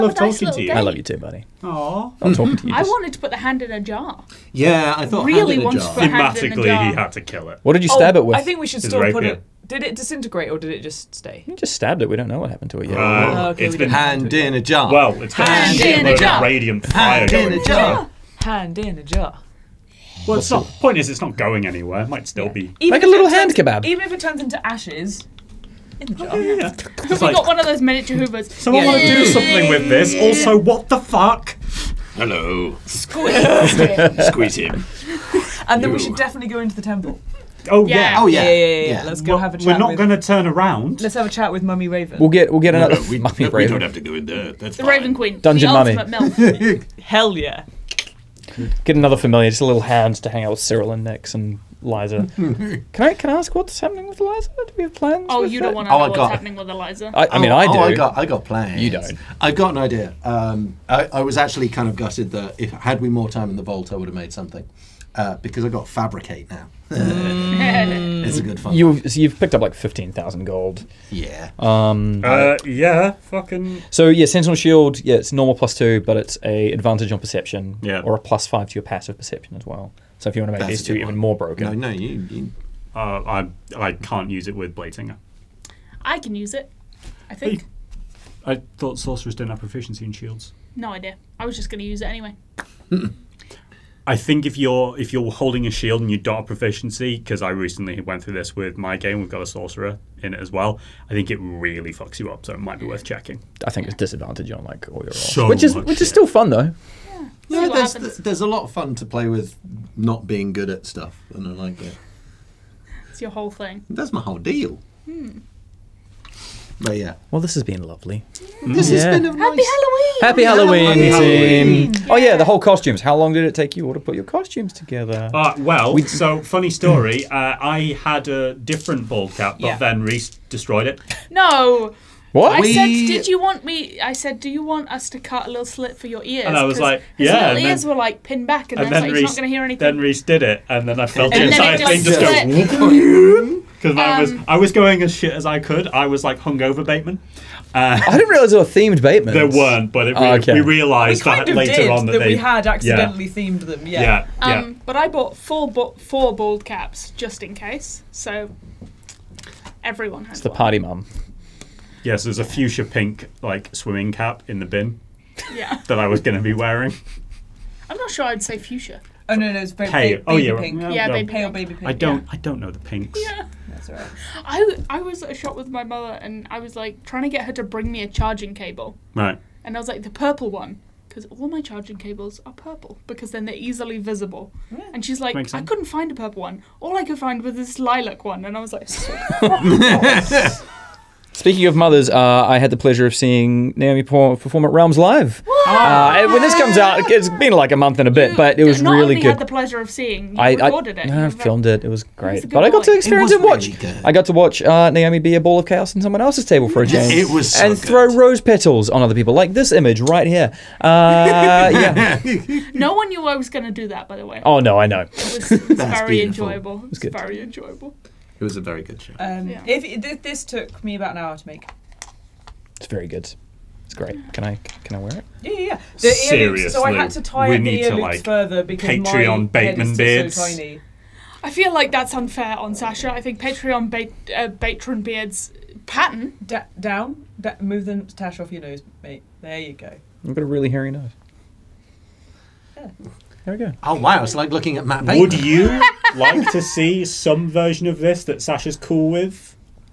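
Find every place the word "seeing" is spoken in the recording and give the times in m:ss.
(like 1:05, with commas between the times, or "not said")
3:13, 3:19.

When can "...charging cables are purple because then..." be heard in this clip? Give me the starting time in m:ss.
3:01.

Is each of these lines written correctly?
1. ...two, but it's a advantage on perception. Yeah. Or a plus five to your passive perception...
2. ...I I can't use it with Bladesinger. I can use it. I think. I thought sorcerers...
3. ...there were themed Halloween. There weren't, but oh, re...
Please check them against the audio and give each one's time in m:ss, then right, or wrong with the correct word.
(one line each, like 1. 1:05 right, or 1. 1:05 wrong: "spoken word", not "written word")
1. 1:15 right
2. 1:23 right
3. 2:28 wrong: "Batemans", not "Halloween".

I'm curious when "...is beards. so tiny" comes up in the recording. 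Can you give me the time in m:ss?
3:49.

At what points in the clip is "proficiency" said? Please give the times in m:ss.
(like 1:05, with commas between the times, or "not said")
1:29, 1:36.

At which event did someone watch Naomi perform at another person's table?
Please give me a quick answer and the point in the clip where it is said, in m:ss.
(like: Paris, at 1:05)
Realms Live, at 3:14.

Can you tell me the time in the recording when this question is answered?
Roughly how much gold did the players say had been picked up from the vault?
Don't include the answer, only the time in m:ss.
1:09.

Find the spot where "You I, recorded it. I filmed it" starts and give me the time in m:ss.
3:20.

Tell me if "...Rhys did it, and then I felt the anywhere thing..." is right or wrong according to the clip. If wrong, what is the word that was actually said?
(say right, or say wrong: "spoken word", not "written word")
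wrong: "entire", not "anywhere".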